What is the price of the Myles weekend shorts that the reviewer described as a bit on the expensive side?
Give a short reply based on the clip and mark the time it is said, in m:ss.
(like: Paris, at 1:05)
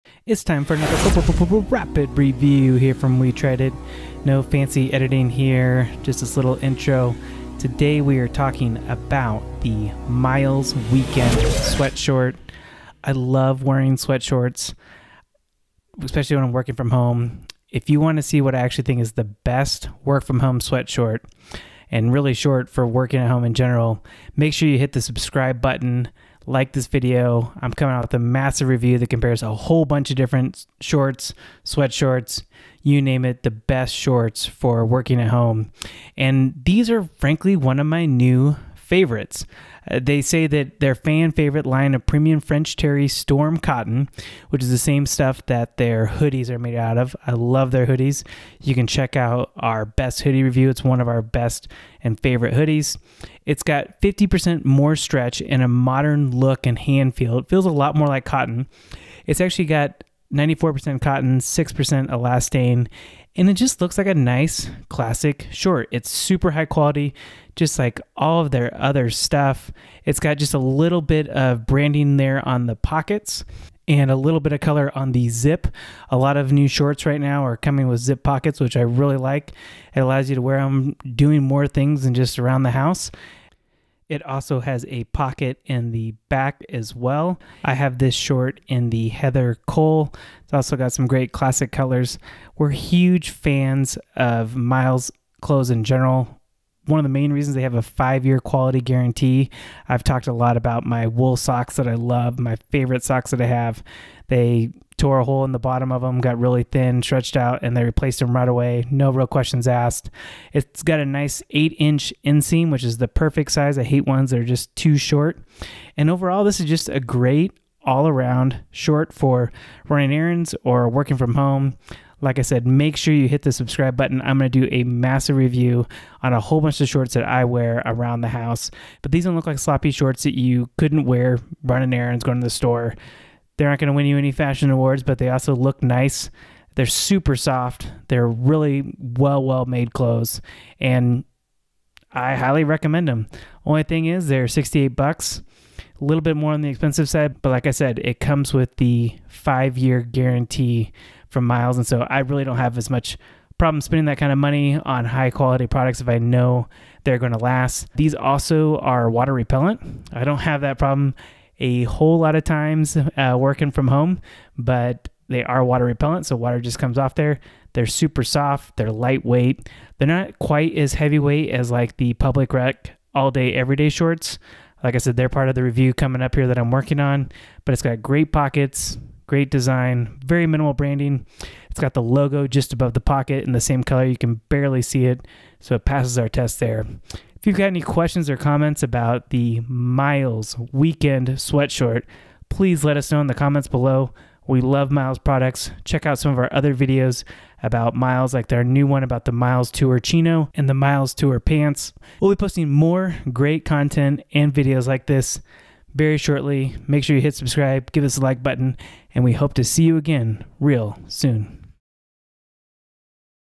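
$68, at 2:24.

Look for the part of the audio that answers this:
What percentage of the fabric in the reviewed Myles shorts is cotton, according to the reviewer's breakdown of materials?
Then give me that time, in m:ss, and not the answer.
1:00.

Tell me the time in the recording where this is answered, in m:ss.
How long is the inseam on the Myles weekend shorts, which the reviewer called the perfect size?
1:51.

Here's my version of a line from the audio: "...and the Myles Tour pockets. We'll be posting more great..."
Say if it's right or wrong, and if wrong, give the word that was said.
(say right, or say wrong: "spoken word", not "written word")
wrong: "pants", not "pockets".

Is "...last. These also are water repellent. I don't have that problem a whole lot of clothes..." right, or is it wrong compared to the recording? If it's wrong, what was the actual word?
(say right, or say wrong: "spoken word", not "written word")
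wrong: "times", not "clothes".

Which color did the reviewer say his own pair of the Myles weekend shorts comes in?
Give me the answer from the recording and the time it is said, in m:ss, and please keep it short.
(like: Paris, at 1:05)
Heather Cole, at 1:29.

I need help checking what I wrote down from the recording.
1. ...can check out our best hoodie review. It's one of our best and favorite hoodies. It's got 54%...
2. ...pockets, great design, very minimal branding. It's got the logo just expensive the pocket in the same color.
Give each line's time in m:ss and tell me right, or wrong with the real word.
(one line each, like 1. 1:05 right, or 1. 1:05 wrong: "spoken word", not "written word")
1. 0:48 wrong: "50", not "54"
2. 2:58 wrong: "above", not "expensive".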